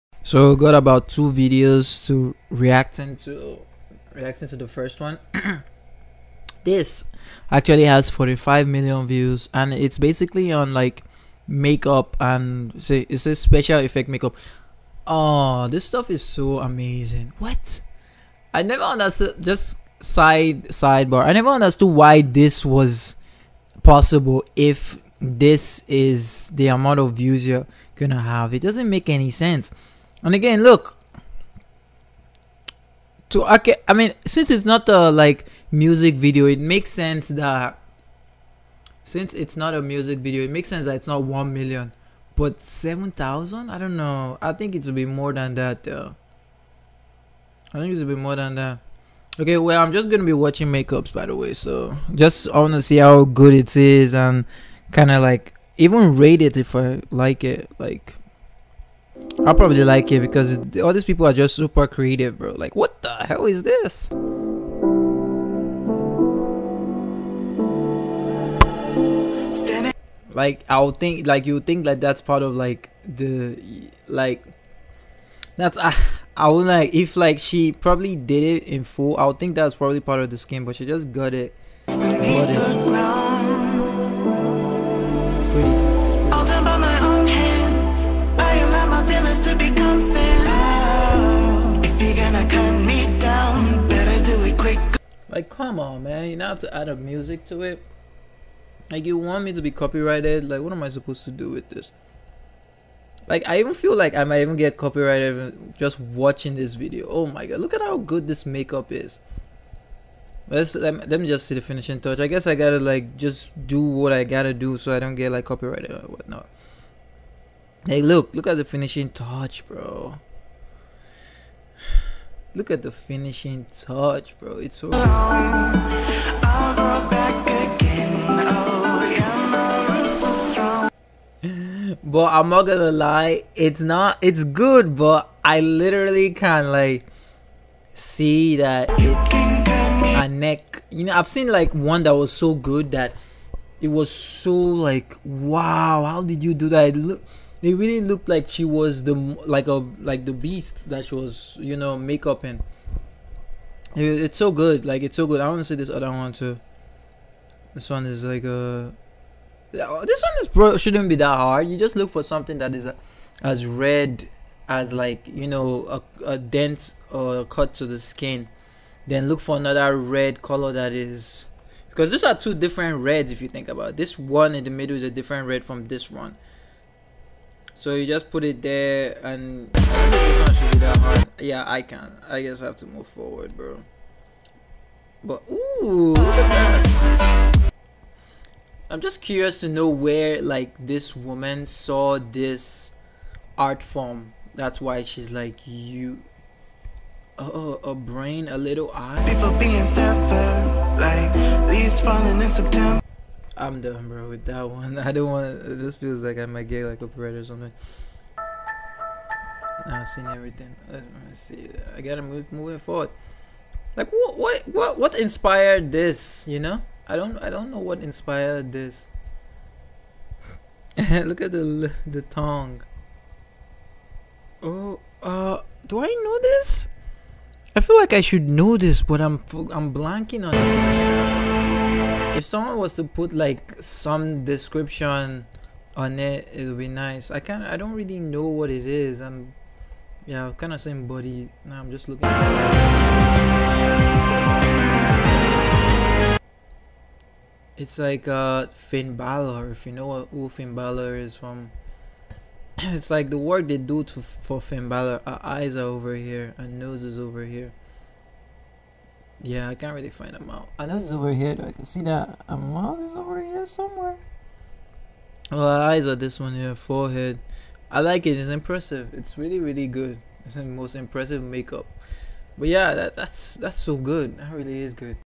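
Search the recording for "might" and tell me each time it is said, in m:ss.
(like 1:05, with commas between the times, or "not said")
1:44, 3:26.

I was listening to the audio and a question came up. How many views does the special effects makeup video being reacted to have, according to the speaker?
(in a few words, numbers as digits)
45 million.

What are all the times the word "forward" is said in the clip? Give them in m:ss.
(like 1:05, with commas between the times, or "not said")
3:03, 3:32.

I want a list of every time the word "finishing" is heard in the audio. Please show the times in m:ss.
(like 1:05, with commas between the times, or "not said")
1:51, 1:58, 2:02.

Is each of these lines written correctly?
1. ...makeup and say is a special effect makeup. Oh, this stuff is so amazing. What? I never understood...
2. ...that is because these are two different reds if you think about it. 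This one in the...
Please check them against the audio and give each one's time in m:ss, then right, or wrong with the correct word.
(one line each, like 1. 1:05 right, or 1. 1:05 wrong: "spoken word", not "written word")
1. 0:11 right
2. 2:50 right.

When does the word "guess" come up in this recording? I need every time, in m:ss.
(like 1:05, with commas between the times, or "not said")
1:52, 3:02.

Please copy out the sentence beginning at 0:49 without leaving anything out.
Okay, well, I'm just gonna be watching makeups, by the way.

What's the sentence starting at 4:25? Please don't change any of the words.
Well, eyes are this one here, forehead.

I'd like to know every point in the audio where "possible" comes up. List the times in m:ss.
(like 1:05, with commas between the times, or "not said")
0:23.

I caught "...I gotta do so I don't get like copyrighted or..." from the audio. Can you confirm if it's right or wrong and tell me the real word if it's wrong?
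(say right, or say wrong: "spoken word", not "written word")
right.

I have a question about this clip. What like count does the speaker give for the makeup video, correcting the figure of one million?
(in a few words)
7,000.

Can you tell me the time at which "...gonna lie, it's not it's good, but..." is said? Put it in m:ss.
2:12.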